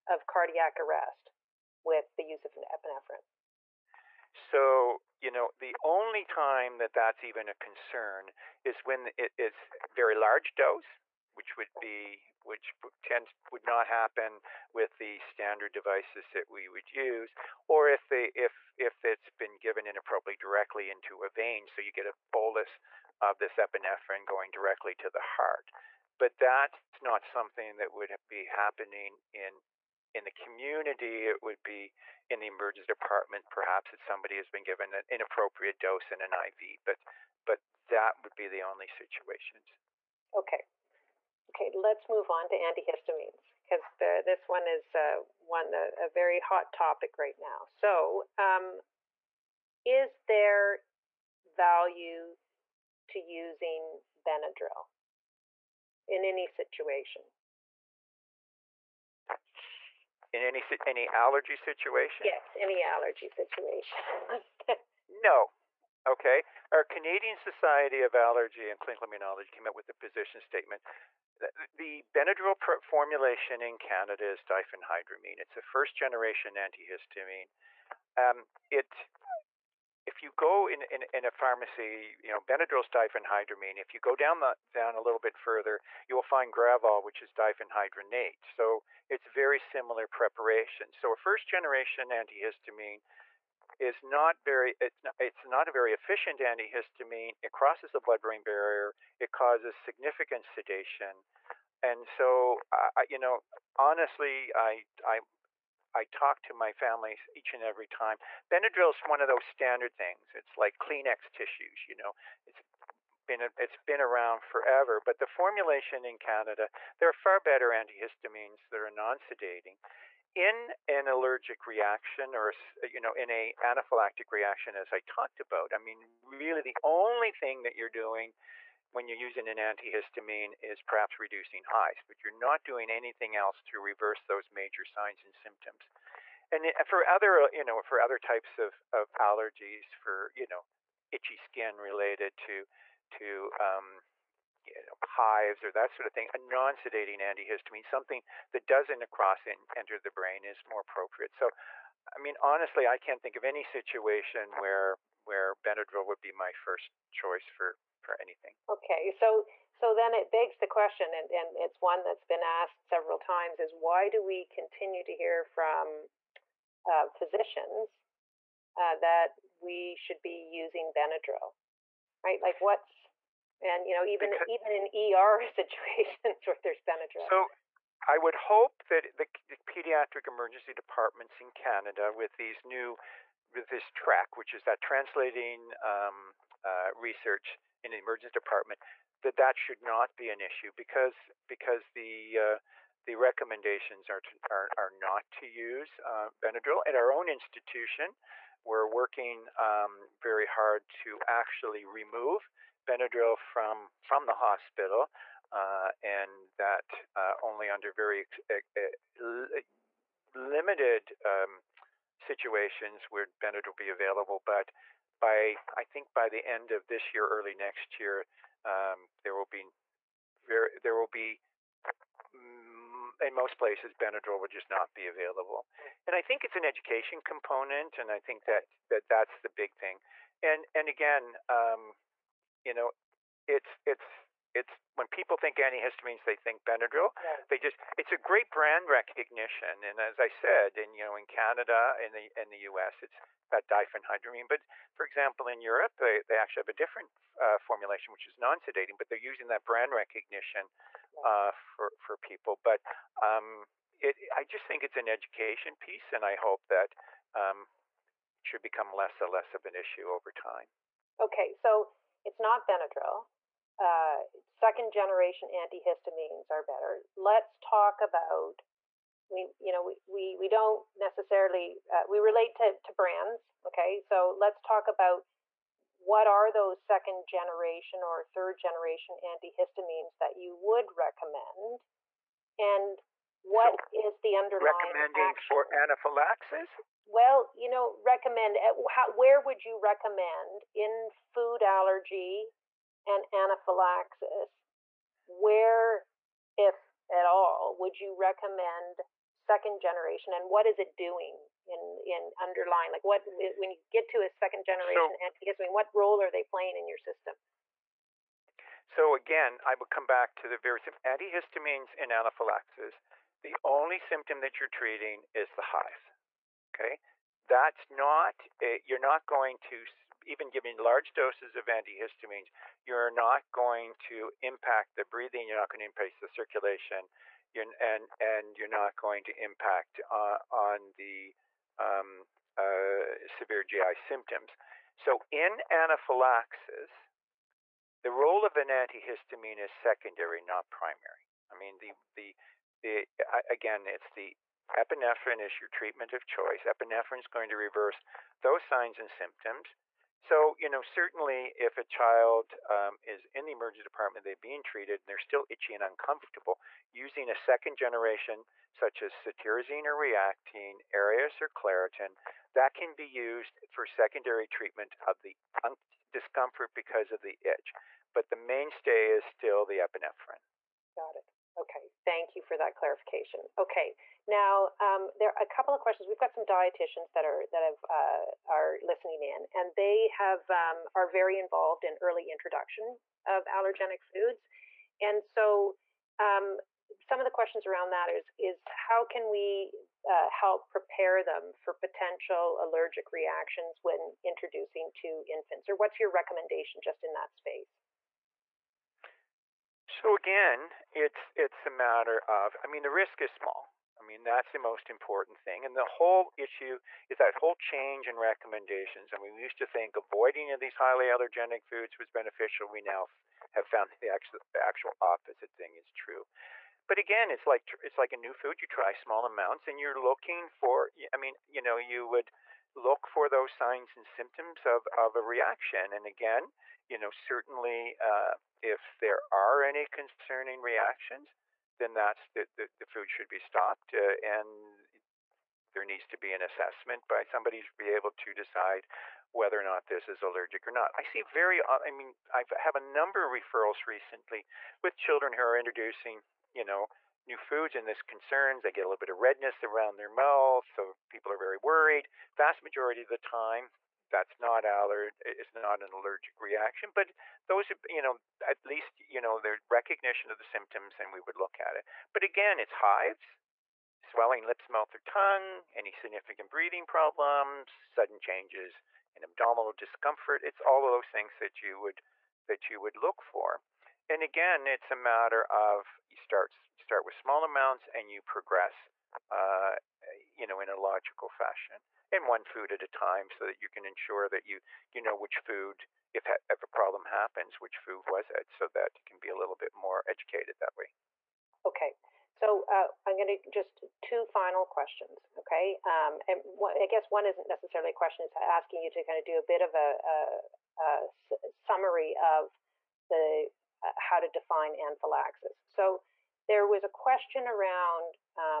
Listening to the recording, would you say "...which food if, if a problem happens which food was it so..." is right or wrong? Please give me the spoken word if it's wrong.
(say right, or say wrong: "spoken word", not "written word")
right.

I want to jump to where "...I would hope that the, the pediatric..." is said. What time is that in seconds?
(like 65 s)
178 s.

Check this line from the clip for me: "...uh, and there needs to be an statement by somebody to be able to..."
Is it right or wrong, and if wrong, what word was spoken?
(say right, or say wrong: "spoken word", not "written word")
wrong: "assessment", not "statement".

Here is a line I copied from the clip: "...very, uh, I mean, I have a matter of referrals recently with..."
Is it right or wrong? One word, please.
wrong.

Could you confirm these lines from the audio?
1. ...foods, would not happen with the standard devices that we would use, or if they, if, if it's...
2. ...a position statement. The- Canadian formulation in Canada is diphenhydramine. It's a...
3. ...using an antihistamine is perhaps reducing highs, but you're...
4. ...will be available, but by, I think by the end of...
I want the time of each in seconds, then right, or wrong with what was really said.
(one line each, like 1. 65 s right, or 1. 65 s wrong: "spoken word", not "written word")
1. 13 s wrong: "tends", not "foods"
2. 69 s wrong: "Benadryl", not "Canadian"
3. 129 s right
4. 213 s right.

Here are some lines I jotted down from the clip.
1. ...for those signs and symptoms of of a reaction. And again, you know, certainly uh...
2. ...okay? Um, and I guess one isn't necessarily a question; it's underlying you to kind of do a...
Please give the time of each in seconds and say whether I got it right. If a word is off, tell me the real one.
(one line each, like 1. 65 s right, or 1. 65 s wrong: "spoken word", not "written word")
1. 423 s right
2. 495 s wrong: "asking", not "underlying".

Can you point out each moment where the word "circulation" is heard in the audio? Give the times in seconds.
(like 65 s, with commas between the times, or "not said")
326 s.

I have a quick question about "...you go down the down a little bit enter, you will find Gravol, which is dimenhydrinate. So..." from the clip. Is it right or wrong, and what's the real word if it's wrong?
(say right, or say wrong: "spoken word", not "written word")
wrong: "further", not "enter".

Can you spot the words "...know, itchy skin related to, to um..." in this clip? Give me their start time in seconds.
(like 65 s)
140 s.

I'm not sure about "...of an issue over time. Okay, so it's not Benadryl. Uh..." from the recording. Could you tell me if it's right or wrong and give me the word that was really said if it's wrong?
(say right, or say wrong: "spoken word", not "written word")
right.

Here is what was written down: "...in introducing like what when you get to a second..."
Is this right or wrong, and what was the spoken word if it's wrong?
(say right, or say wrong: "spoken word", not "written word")
wrong: "underlying", not "introducing".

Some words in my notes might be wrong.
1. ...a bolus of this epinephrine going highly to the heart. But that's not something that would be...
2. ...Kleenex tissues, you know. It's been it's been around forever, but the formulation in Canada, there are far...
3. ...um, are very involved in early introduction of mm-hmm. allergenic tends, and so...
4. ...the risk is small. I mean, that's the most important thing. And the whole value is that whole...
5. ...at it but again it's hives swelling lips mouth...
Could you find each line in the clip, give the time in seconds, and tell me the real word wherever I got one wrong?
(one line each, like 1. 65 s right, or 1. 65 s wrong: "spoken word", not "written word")
1. 22 s wrong: "directly", not "highly"
2. 110 s right
3. 380 s wrong: "foods", not "tends"
4. 402 s wrong: "issue", not "value"
5. 461 s right.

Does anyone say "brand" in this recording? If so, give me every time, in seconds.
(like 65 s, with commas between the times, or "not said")
238 s, 249 s, 272 s.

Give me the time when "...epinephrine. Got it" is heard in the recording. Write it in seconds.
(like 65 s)
369 s.